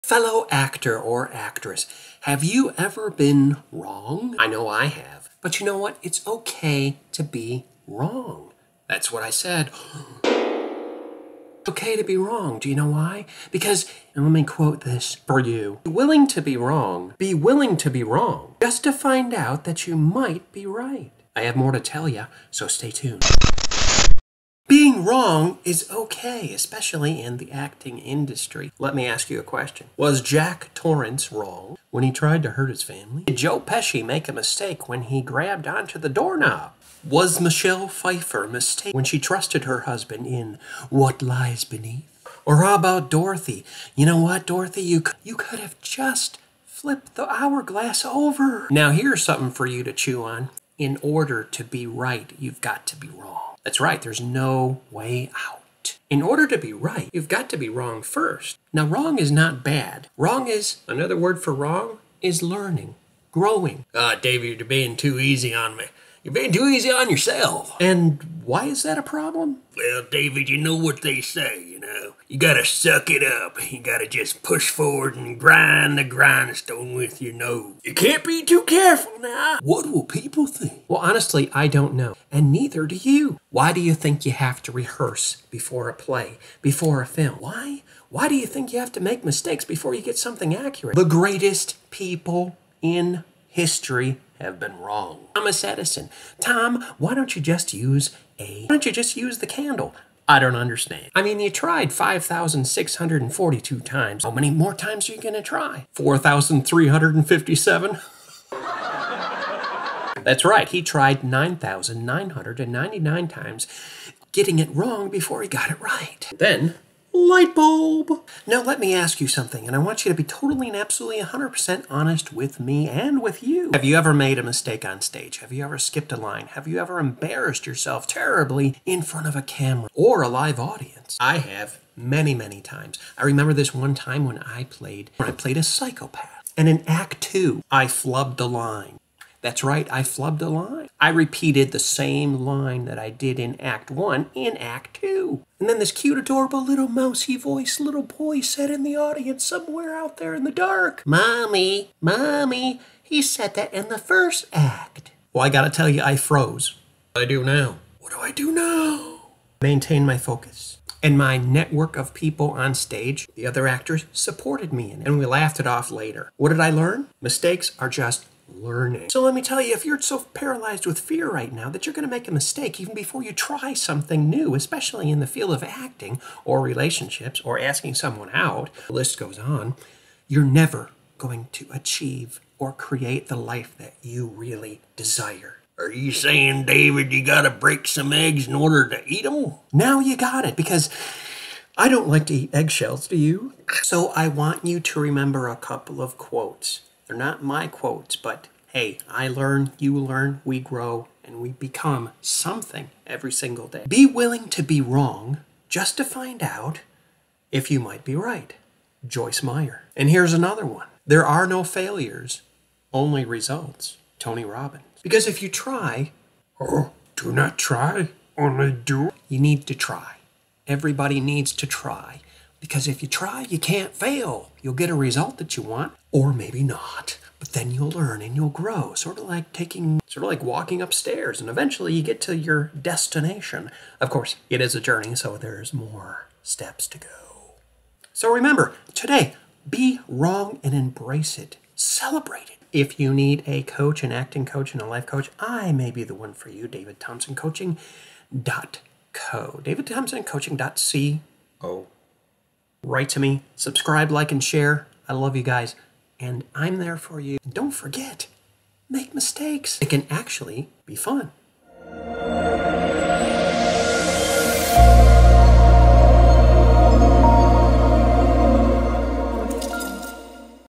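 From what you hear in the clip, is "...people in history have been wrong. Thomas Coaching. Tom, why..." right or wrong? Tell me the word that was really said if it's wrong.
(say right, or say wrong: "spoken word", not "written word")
wrong: "Edison", not "Coaching".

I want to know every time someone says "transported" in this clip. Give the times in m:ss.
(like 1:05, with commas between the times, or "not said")
not said.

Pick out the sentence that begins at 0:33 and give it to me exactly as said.
Did Joe Pesci make a mistake when he grabbed onto the doorknob?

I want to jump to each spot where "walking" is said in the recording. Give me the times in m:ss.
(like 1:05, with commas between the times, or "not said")
3:50.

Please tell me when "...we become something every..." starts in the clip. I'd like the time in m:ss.
3:21.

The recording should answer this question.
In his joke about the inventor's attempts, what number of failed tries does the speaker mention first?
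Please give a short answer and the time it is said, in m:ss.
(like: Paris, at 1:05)
5,642, at 1:41.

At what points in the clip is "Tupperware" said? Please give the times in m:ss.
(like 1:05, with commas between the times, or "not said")
not said.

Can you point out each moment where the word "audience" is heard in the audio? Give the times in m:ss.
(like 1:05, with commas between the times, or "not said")
2:10, 2:28.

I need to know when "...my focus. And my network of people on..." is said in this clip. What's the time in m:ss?
2:40.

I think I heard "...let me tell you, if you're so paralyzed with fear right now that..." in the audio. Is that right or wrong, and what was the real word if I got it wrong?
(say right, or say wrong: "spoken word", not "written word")
right.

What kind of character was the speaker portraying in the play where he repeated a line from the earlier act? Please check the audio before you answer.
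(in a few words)
A psychopath.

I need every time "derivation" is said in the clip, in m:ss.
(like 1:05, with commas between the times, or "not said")
not said.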